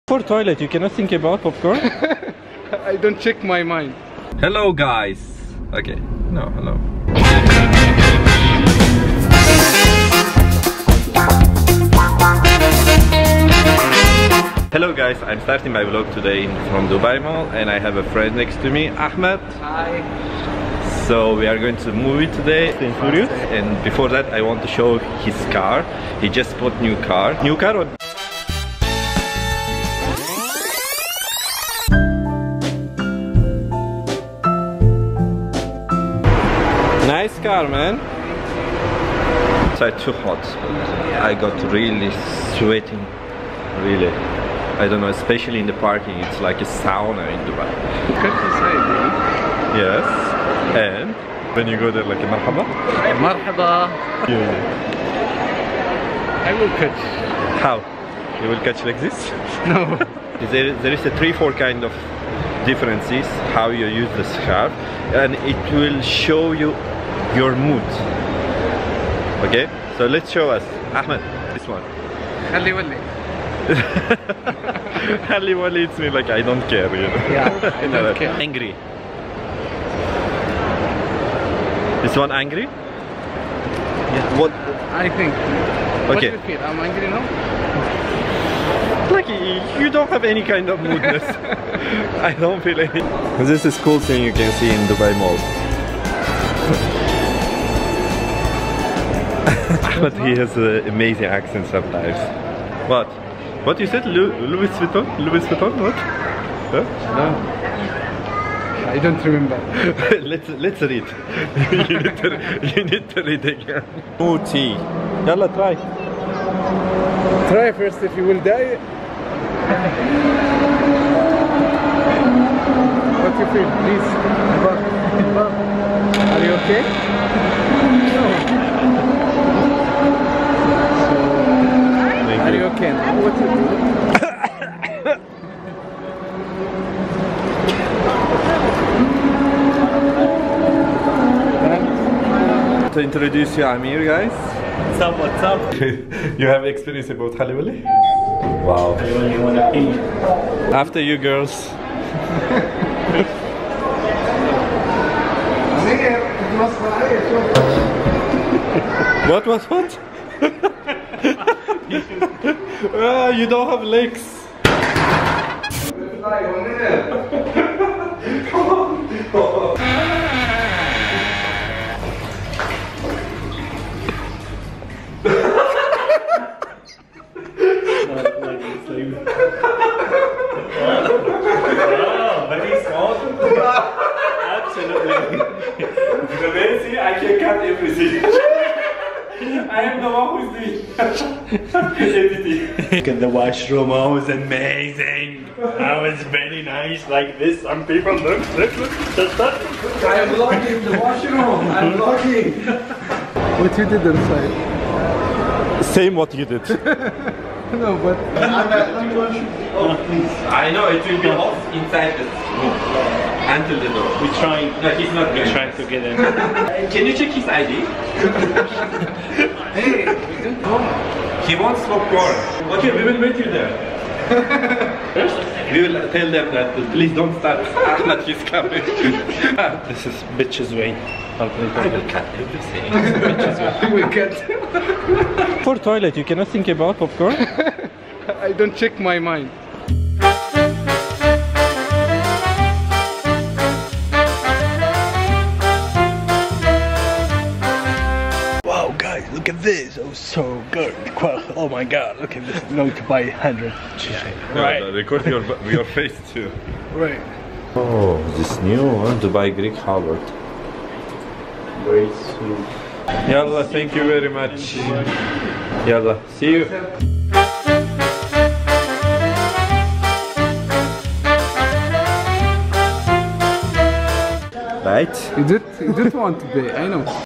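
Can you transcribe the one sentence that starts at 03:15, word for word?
That was very nice, like this.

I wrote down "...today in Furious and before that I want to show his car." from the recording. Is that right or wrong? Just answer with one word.
right.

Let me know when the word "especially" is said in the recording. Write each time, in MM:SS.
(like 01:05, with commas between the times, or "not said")
00:45.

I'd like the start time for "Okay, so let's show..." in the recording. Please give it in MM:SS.
01:09.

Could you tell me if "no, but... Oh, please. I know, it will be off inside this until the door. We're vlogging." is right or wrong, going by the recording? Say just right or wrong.
wrong.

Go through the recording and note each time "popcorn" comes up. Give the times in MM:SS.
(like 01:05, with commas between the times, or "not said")
00:01, 03:56.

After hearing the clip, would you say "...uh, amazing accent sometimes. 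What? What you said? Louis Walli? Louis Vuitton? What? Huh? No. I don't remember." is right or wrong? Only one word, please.
wrong.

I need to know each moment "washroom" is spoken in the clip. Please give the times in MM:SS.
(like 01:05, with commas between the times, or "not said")
03:13, 03:20.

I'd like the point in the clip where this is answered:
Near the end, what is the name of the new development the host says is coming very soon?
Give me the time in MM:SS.
04:19.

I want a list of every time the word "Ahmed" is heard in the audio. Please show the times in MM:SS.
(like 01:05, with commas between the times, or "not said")
00:18, 01:10, 03:47.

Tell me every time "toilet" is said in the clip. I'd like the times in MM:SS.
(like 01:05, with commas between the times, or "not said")
00:00, 03:55.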